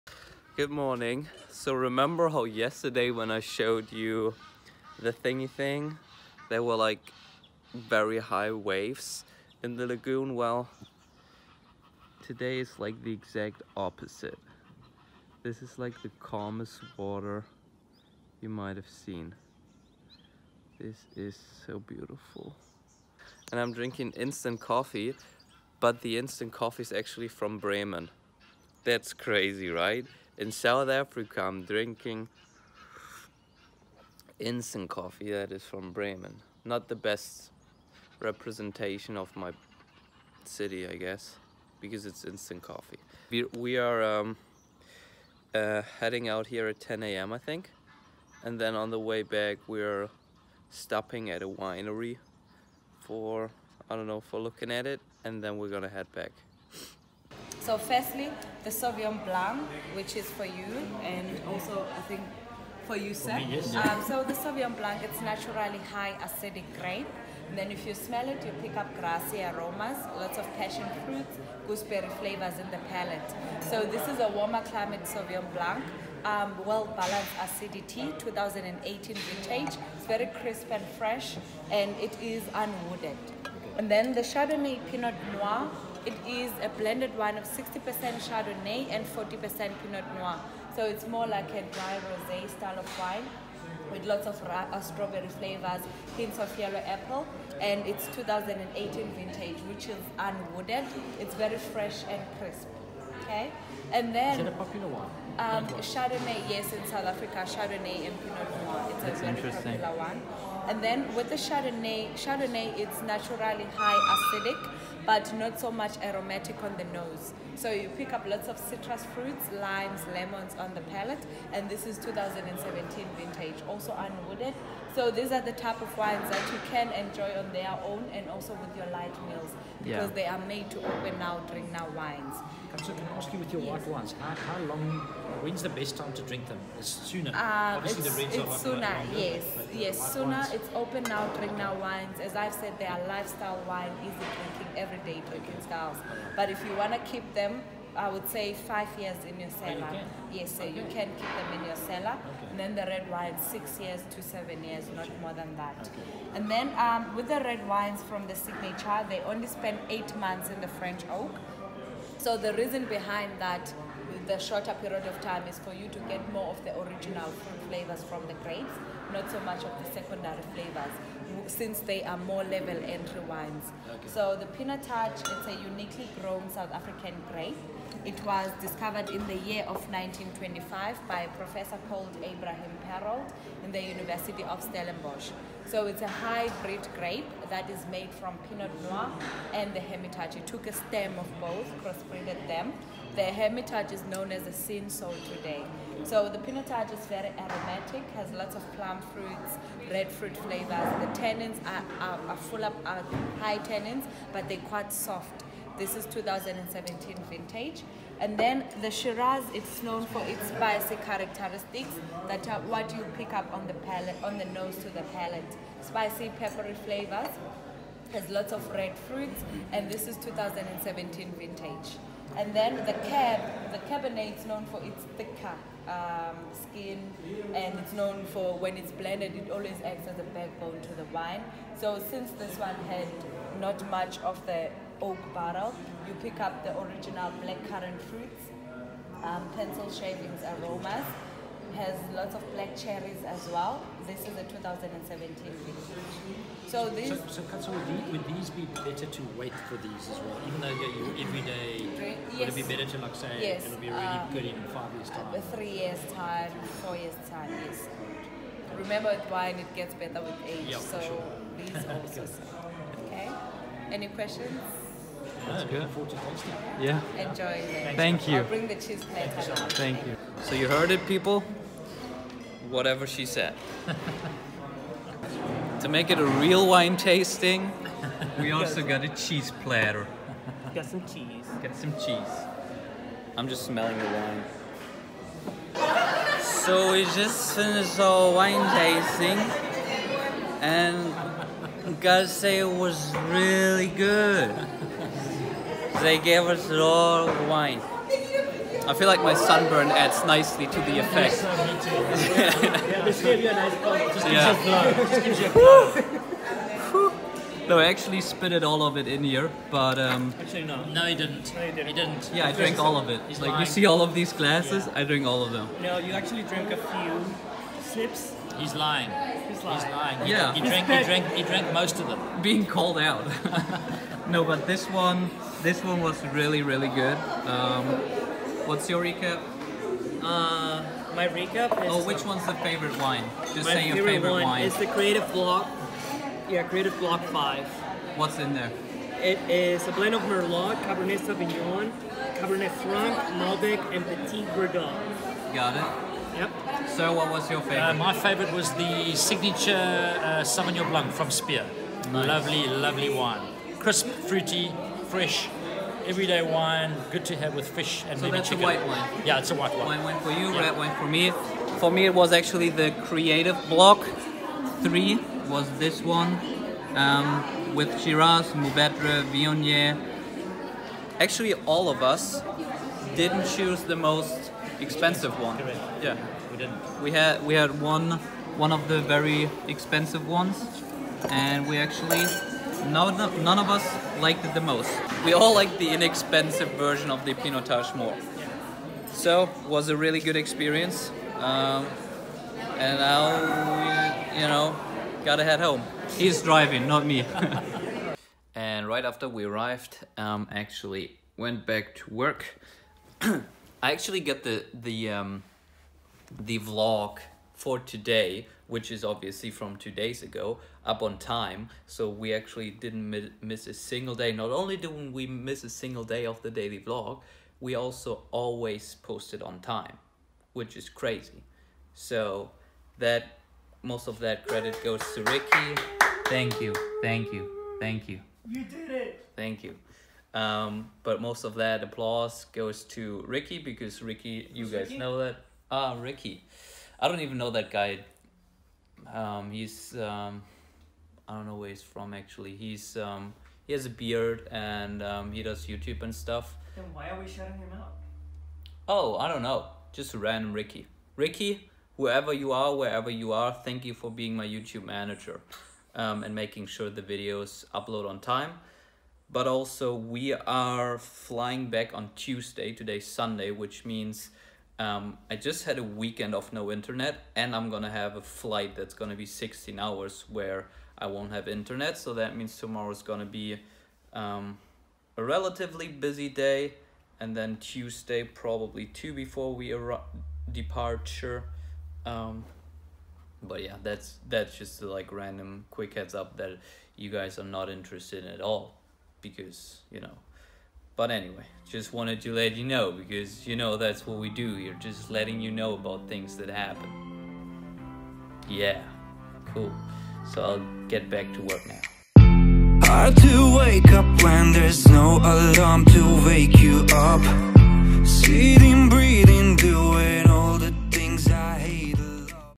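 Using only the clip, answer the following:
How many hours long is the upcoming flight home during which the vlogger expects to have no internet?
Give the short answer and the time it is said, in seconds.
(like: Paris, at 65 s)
16, at 469 s.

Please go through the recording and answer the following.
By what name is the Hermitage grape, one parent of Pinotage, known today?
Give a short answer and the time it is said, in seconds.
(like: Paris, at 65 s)
Cinsault, at 194 s.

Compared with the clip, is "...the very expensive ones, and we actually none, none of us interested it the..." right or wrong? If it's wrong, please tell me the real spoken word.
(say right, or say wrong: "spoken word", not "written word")
wrong: "liked", not "interested".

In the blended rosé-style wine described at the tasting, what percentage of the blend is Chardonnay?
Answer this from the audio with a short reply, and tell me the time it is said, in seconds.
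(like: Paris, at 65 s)
60%, at 87 s.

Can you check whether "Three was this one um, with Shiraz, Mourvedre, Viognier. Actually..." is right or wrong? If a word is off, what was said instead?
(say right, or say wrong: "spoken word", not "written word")
right.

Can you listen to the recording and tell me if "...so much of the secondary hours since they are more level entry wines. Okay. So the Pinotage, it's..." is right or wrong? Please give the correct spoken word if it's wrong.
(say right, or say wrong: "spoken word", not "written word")
wrong: "flavors", not "hours".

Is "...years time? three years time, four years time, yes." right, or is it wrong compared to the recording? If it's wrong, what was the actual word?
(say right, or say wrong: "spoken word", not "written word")
right.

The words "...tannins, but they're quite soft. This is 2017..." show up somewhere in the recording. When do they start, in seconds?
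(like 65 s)
203 s.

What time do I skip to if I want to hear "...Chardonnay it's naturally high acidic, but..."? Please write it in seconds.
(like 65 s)
112 s.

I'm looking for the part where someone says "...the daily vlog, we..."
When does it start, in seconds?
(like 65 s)
416 s.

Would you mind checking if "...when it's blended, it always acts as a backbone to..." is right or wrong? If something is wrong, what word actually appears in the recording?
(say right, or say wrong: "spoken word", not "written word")
right.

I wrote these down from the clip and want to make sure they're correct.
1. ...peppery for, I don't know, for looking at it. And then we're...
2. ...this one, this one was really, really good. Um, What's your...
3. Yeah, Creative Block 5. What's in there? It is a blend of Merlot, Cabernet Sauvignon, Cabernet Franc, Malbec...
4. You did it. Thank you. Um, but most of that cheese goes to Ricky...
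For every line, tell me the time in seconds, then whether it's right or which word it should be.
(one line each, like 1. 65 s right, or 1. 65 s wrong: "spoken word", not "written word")
1. 51 s wrong: "winery", not "peppery"
2. 324 s right
3. 336 s right
4. 428 s wrong: "applause", not "cheese".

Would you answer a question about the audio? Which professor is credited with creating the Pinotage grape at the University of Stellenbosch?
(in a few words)
Abraham Perold.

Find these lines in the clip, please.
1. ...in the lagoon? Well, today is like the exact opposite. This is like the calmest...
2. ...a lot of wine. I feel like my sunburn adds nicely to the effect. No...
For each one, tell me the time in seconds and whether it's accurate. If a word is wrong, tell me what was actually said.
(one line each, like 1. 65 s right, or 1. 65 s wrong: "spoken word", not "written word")
1. 9 s right
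2. 296 s right.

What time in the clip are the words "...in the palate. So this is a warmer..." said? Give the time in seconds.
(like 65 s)
72 s.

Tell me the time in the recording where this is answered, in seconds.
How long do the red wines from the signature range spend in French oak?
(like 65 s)
159 s.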